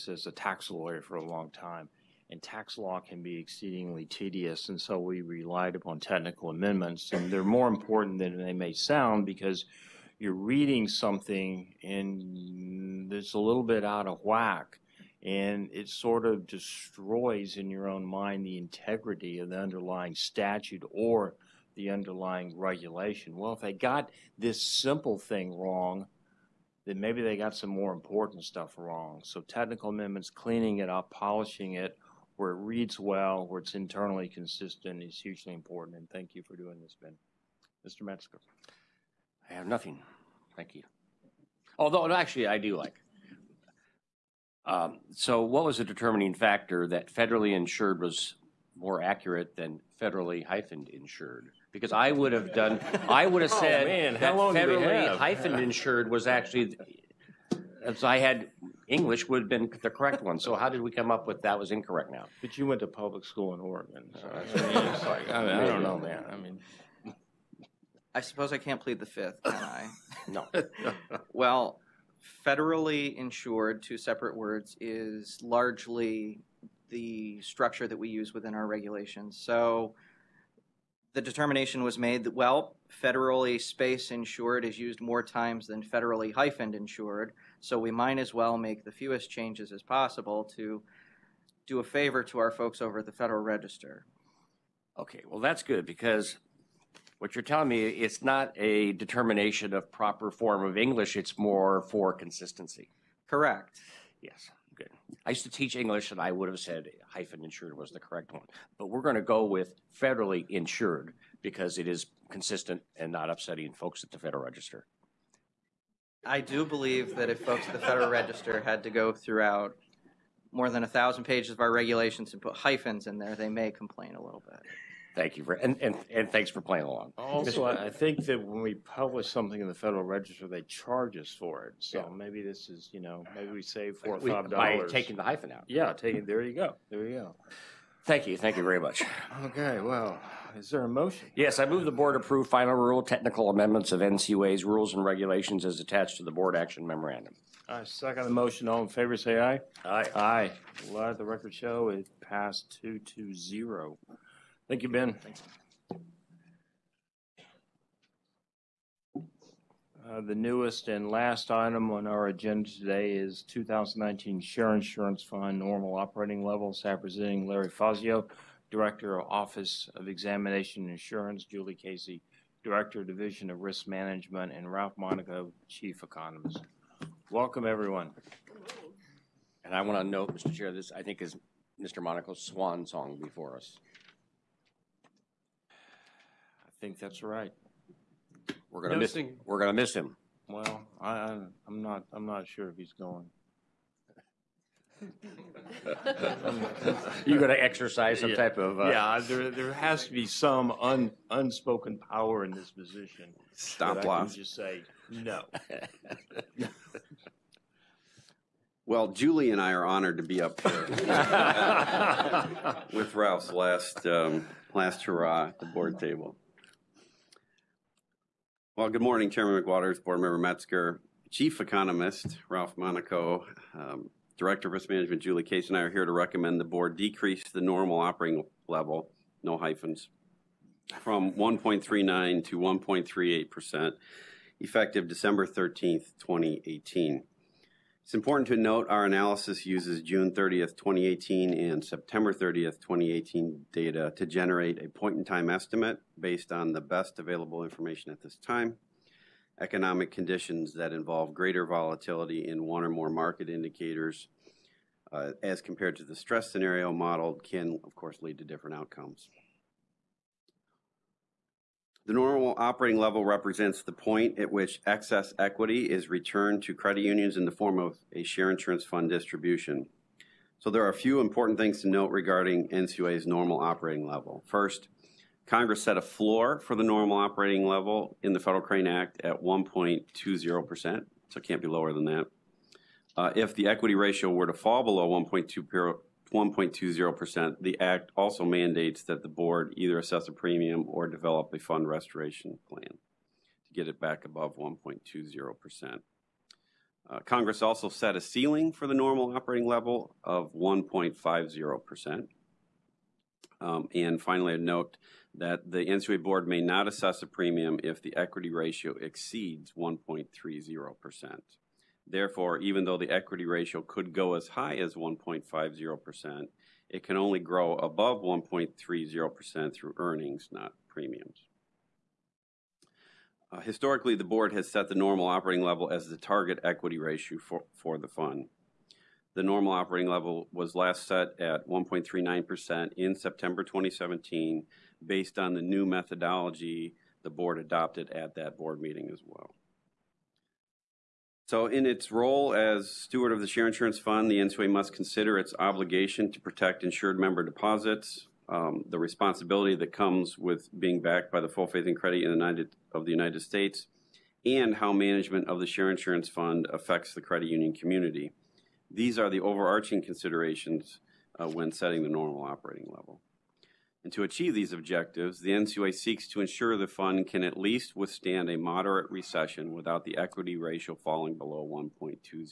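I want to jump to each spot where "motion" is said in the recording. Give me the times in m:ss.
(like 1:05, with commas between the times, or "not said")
2:20, 2:28.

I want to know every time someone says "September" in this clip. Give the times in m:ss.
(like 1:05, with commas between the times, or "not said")
4:01, 5:33.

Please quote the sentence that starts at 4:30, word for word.
So there are a few important things to note regarding NCUA's normal operating level.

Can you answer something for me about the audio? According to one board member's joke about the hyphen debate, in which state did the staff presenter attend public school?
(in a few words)
Oregon.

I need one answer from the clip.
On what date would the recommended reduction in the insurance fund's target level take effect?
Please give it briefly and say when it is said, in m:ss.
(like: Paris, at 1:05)
December 13th, 2018, at 3:55.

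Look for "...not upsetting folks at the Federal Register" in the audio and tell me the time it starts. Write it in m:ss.
1:53.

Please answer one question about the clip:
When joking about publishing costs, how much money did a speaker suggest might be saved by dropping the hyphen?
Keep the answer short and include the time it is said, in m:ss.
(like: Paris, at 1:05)
4 or 5 dollars, at 2:13.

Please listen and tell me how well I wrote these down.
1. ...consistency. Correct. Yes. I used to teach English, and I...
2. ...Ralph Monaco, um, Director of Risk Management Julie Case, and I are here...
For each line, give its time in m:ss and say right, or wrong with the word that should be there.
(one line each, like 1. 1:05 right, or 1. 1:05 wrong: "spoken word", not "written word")
1. 1:42 right
2. 3:42 right.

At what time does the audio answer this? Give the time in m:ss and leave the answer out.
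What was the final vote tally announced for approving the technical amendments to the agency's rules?
2:32.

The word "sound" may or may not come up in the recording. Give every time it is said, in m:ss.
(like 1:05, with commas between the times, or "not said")
0:08.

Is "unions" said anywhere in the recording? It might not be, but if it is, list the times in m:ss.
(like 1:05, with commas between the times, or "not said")
4:27, 5:57.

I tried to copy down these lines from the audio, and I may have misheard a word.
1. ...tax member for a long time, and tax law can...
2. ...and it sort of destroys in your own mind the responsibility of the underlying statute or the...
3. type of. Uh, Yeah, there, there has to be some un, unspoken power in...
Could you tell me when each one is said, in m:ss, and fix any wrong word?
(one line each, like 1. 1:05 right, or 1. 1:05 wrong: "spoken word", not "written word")
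1. 0:00 wrong: "lawyer", not "member"
2. 0:15 wrong: "integrity", not "responsibility"
3. 3:18 right.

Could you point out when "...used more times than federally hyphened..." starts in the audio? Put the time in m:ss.
1:24.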